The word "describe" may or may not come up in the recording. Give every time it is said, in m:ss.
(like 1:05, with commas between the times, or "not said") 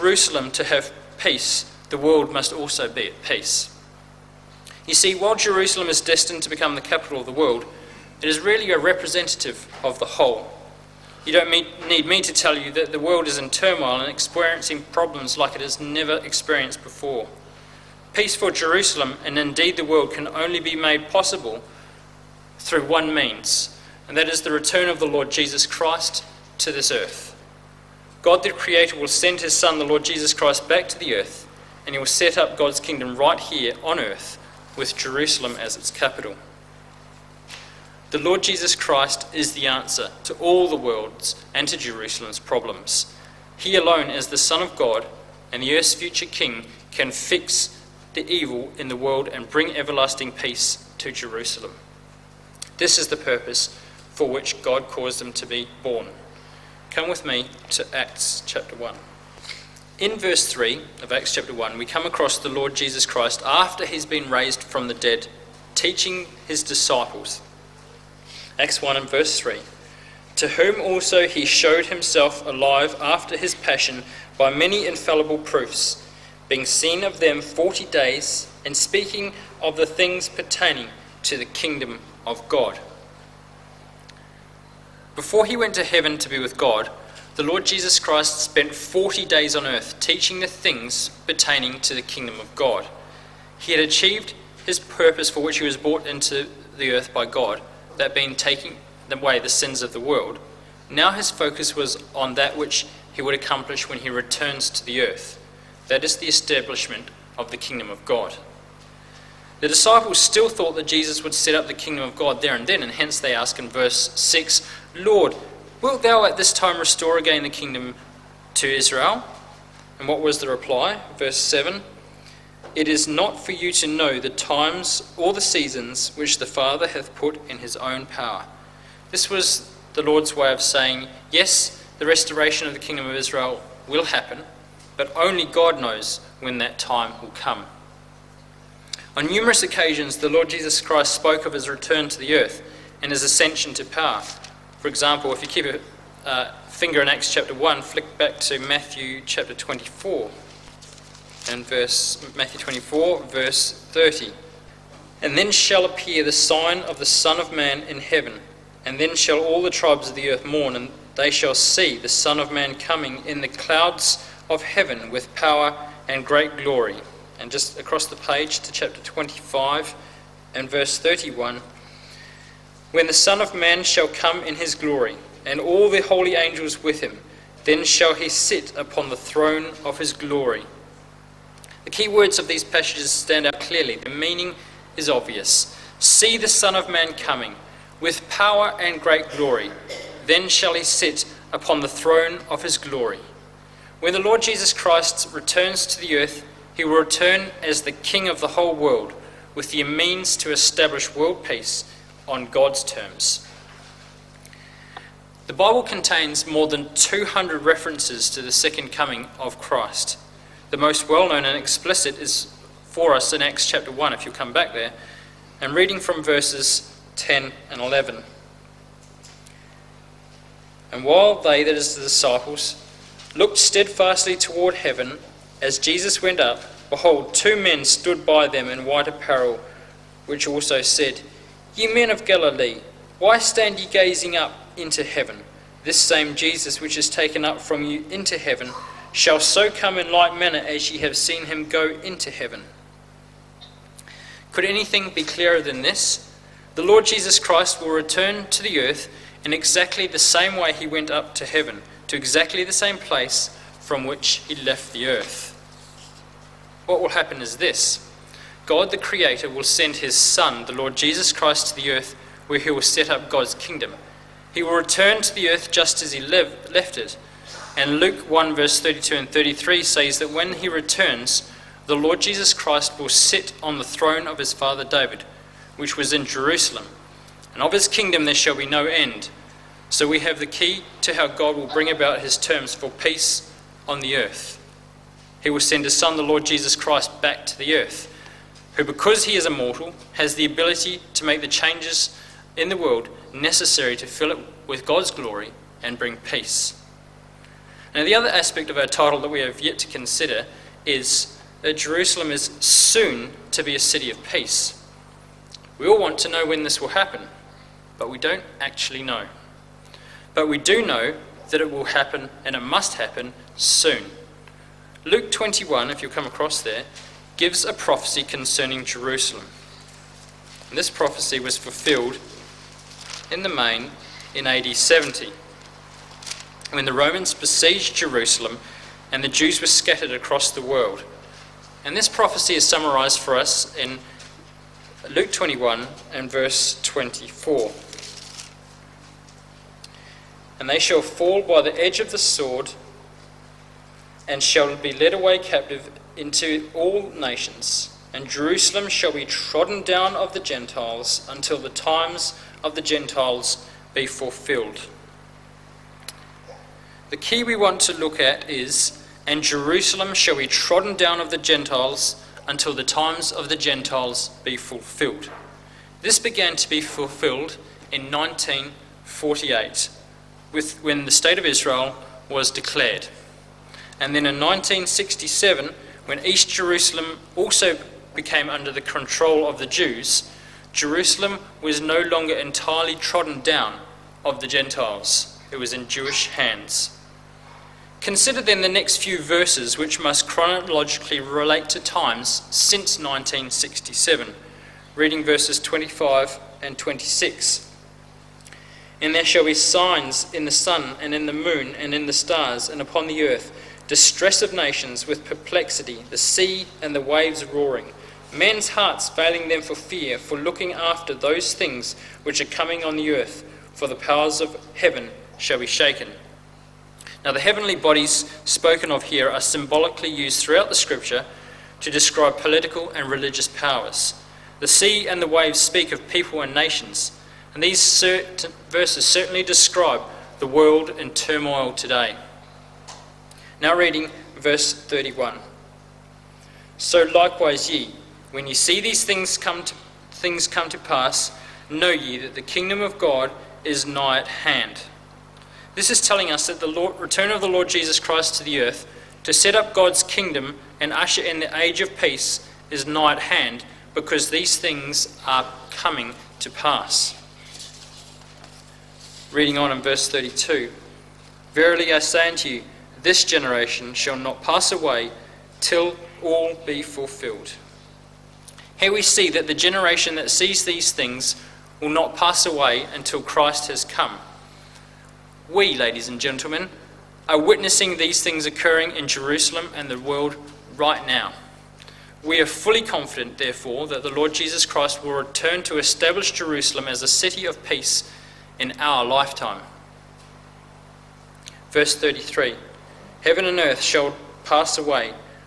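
7:01, 7:09.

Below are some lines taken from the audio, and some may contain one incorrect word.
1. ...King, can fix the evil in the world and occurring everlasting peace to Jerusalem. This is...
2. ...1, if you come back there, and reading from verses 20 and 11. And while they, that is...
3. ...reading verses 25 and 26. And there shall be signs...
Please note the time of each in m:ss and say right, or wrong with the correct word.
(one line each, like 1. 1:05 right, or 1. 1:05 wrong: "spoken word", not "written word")
1. 0:46 wrong: "bring", not "occurring"
2. 3:33 wrong: "10", not "20"
3. 6:34 right.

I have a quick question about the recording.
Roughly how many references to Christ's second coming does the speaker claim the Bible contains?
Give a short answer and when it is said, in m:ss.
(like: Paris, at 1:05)
more than 200, at 3:26.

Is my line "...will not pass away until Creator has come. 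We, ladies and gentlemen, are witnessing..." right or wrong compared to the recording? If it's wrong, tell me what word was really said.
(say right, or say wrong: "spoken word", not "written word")
wrong: "Christ", not "Creator".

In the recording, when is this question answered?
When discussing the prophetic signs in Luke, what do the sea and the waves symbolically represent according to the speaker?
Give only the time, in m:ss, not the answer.
7:06.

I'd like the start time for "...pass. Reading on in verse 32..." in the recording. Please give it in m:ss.
7:36.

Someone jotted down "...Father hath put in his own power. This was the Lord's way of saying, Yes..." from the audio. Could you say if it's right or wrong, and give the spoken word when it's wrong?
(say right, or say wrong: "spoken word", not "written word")
right.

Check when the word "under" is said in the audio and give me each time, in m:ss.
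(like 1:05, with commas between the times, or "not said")
6:18.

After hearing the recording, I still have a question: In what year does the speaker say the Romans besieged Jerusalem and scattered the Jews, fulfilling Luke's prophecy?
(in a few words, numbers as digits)
AD 70.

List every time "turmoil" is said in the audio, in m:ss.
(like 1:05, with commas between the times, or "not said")
0:13, 7:11.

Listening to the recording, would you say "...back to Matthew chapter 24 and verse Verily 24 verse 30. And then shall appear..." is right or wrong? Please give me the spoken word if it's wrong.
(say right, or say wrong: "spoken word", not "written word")
wrong: "Matthew", not "Verily".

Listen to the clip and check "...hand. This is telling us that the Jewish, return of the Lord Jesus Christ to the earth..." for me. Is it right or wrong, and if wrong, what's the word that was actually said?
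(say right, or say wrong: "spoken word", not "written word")
wrong: "Lord", not "Jewish".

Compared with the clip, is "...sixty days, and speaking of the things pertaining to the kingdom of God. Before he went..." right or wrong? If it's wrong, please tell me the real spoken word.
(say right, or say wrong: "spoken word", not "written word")
wrong: "forty", not "sixty".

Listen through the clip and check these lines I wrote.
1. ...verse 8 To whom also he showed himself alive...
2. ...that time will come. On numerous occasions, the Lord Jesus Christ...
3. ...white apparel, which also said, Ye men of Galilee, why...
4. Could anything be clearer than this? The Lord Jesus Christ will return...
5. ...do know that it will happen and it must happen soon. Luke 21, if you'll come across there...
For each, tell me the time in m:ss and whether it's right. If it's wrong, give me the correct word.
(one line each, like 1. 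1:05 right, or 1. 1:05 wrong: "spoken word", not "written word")
1. 1:09 wrong: "3", not "8"
2. 2:16 right
3. 3:48 right
4. 4:04 right
5. 5:10 right.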